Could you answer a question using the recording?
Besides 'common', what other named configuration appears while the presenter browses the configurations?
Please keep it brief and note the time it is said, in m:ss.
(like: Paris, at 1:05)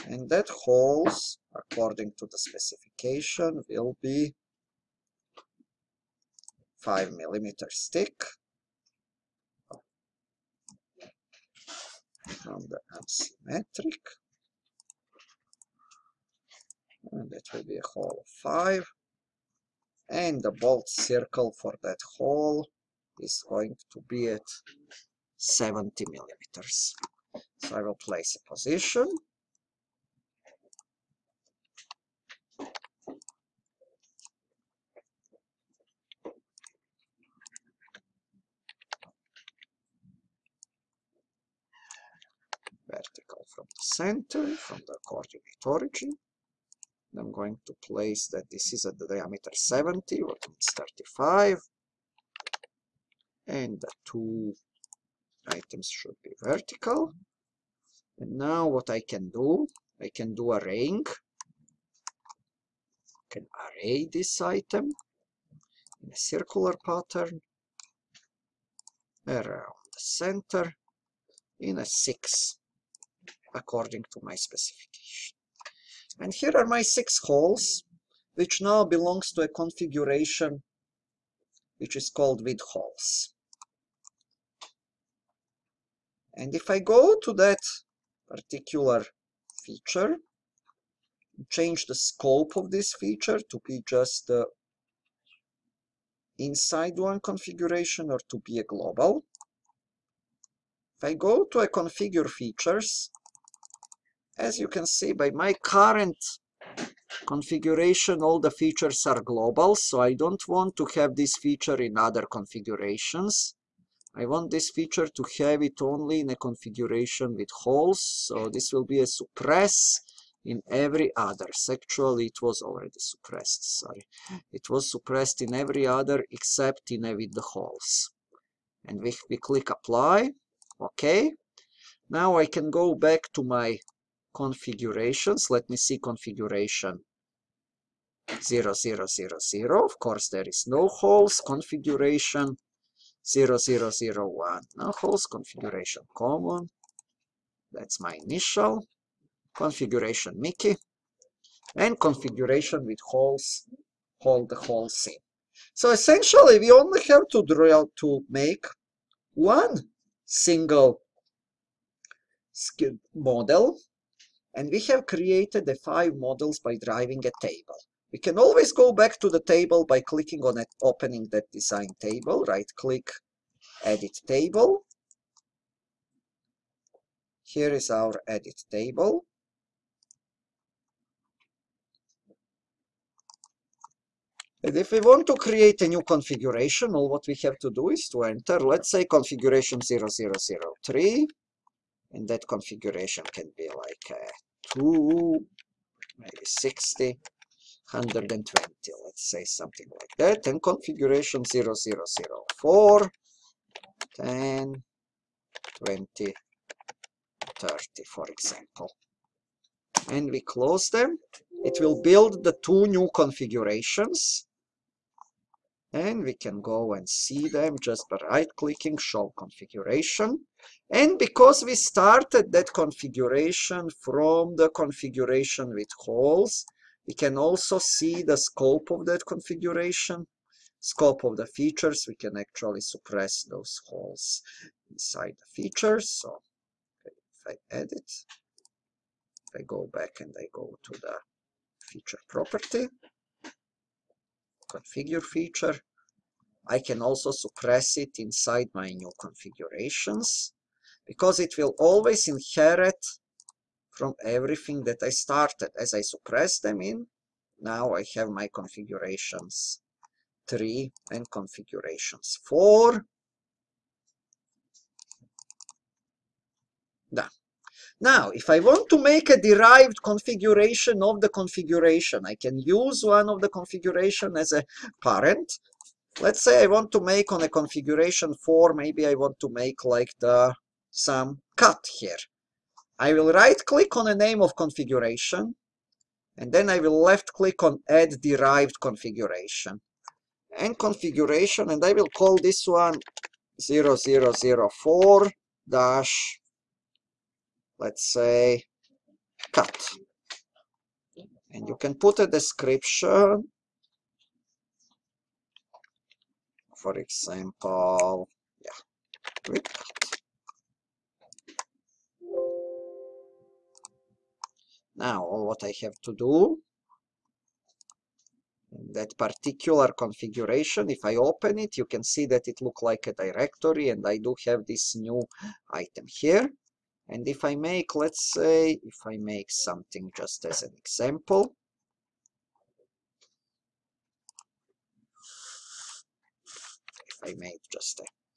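Mickey, at 2:30.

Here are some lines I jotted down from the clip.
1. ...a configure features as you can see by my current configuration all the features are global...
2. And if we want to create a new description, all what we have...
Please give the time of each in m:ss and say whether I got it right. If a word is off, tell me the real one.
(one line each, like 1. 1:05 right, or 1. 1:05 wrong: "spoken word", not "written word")
1. 1:41 right
2. 3:04 wrong: "configuration", not "description".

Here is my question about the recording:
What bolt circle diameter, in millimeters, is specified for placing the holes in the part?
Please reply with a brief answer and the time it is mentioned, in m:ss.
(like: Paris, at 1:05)
70, at 0:25.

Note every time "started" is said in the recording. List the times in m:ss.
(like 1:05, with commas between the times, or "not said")
3:41, 4:15.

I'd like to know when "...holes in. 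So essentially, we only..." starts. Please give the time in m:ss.
2:34.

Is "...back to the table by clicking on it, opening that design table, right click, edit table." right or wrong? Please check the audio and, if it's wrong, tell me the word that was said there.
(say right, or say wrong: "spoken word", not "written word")
right.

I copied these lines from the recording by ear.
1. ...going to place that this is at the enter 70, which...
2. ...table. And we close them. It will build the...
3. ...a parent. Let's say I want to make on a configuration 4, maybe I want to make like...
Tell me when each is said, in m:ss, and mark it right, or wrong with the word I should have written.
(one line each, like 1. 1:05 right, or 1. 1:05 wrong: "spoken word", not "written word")
1. 0:47 wrong: "diameter", not "enter"
2. 3:28 wrong: "example", not "table"
3. 4:34 right.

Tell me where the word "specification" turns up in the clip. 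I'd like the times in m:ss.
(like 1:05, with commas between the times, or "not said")
0:02, 1:14.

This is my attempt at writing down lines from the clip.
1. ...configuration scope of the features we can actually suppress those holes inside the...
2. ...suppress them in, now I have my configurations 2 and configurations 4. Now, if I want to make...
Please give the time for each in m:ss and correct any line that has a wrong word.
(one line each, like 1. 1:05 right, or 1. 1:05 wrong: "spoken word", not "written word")
1. 3:49 right
2. 4:16 wrong: "3", not "2".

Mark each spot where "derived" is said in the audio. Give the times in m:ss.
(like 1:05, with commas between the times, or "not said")
4:29, 4:48.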